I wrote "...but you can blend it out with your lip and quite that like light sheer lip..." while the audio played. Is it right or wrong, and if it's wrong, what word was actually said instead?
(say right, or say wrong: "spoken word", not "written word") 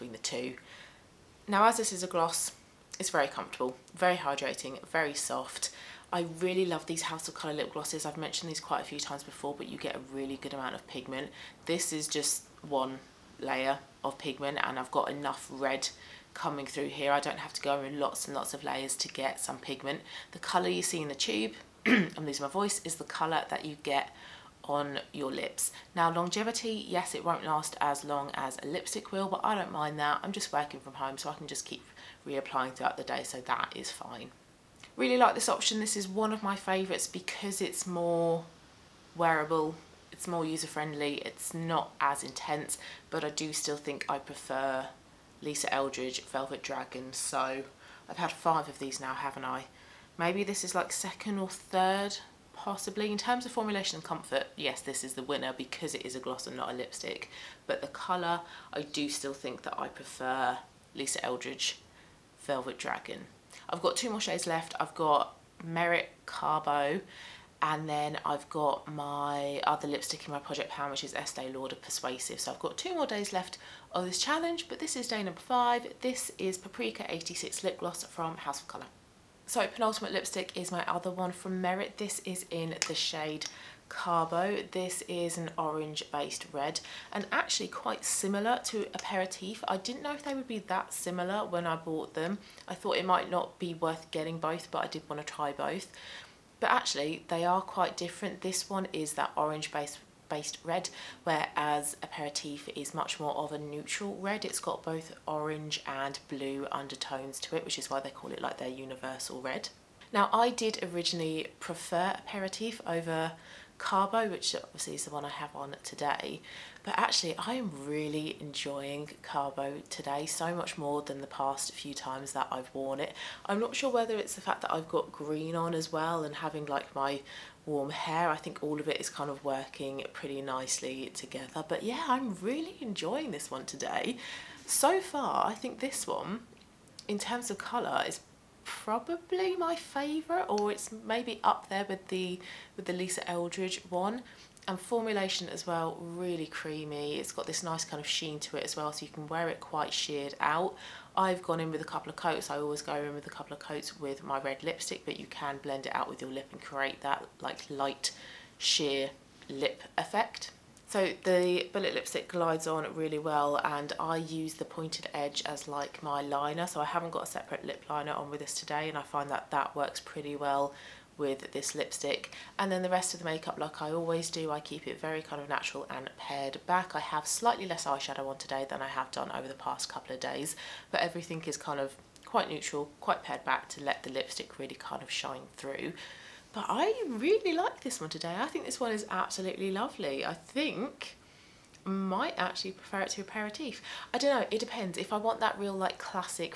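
wrong: "create", not "quite".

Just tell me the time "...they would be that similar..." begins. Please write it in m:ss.
1:30.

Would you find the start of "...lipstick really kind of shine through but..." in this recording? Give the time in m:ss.
3:04.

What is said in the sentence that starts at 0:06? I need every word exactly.
I really love these House of Colour lip glosses.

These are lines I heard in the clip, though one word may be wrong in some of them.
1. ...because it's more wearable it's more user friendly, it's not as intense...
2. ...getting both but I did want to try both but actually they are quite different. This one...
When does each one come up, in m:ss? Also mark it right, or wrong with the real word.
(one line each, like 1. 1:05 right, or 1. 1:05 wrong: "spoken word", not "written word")
1. 0:37 right
2. 1:34 right.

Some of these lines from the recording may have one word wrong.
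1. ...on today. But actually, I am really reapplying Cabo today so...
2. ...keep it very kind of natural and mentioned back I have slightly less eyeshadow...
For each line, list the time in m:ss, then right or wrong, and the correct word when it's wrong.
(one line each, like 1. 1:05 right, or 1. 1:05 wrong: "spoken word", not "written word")
1. 1:55 wrong: "enjoying", not "reapplying"
2. 2:54 wrong: "paired", not "mentioned".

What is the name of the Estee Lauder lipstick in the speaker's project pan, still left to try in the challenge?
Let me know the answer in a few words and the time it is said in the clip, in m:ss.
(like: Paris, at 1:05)
Persuasive, at 1:11.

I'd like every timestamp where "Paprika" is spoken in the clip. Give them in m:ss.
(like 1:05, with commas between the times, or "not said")
1:16.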